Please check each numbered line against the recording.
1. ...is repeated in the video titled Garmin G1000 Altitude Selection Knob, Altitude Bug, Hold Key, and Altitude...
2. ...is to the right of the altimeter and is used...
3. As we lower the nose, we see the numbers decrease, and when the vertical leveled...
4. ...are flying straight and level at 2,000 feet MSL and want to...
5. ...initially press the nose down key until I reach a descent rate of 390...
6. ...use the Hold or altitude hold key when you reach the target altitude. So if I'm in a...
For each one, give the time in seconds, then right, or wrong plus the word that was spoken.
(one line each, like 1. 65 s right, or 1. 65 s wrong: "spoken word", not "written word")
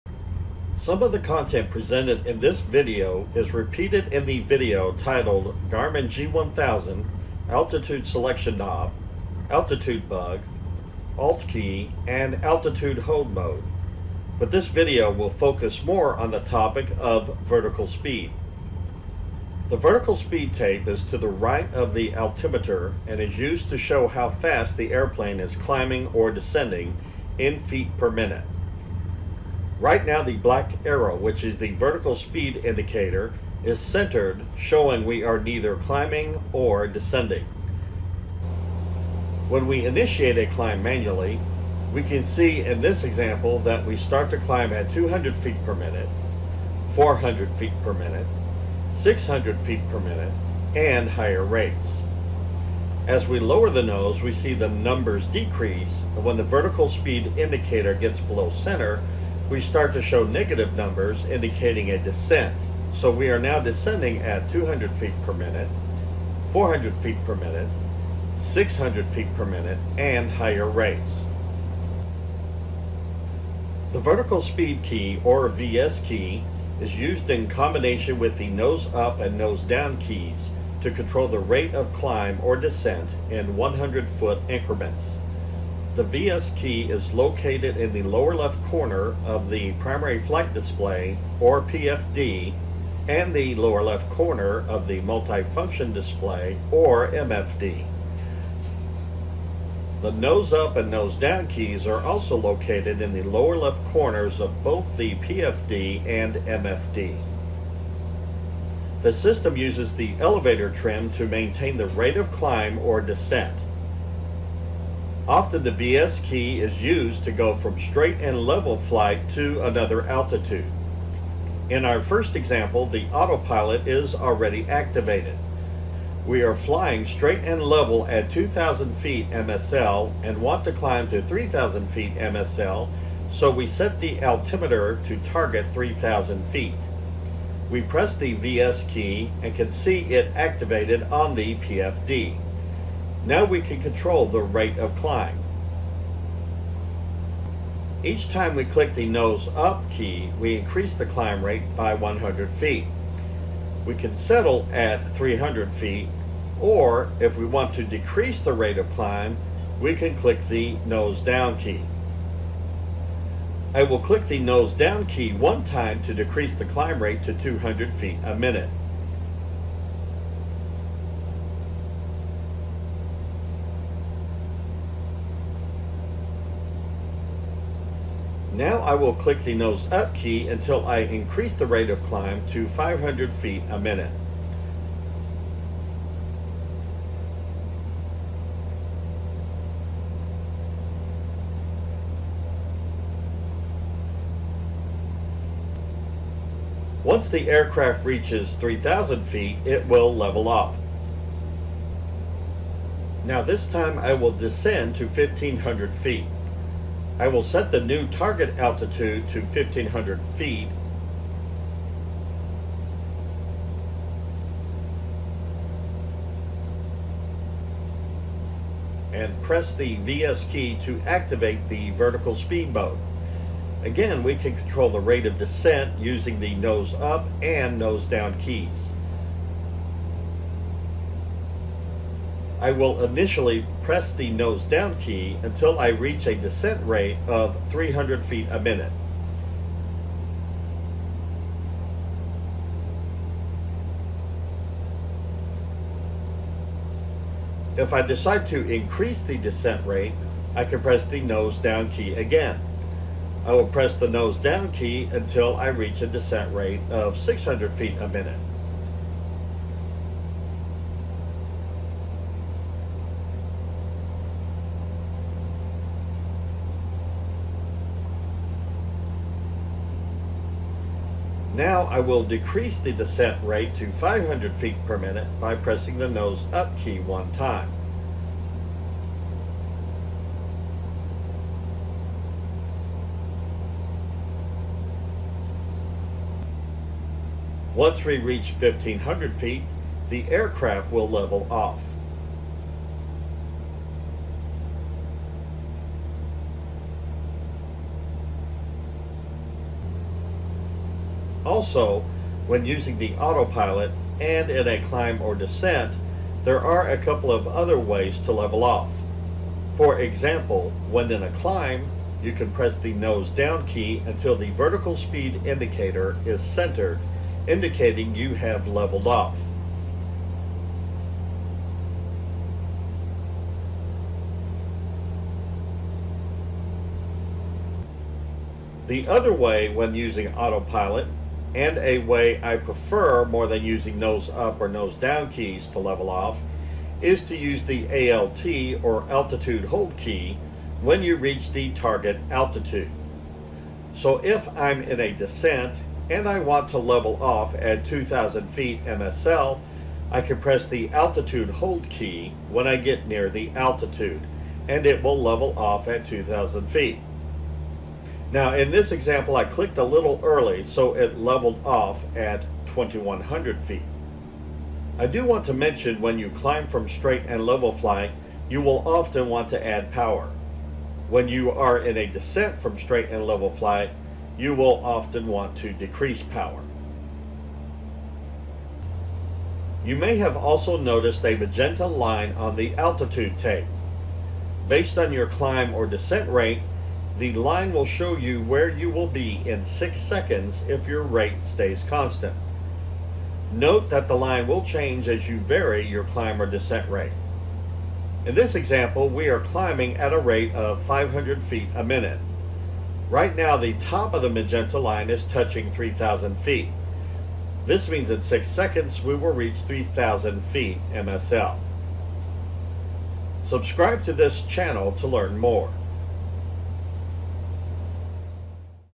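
1. 3 s wrong: "Alt", not "Hold"
2. 20 s right
3. 53 s wrong: "speed", not "leveled"
4. 126 s right
5. 233 s wrong: "300", not "390"
6. 337 s wrong: "ALT", not "Hold".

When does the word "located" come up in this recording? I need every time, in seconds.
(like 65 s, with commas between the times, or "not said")
87 s, 102 s.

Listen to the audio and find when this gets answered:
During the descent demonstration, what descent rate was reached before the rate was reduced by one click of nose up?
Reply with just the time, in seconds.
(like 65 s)
257 s.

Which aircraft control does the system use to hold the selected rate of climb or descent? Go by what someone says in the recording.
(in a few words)
elevator trim.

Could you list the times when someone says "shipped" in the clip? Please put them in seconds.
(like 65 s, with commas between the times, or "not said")
not said.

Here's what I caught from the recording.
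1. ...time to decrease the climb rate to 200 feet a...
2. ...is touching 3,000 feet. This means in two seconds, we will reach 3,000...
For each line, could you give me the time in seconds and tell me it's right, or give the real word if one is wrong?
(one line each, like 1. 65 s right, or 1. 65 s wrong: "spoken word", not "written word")
1. 165 s right
2. 405 s wrong: "six", not "two".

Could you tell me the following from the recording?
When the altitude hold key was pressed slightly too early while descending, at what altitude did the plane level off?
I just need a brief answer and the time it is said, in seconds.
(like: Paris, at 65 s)
2100 feet, at 362 s.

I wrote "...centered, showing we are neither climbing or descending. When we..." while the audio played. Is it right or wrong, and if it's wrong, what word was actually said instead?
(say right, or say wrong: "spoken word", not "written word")
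right.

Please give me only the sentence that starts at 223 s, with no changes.
Again, we can control the rate of descent using the nose up and nose down keys.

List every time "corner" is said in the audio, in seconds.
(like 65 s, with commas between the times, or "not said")
88 s, 94 s, 103 s.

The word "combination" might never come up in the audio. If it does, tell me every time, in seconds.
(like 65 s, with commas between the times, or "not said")
77 s.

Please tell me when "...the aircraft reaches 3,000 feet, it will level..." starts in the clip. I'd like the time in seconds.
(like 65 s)
197 s.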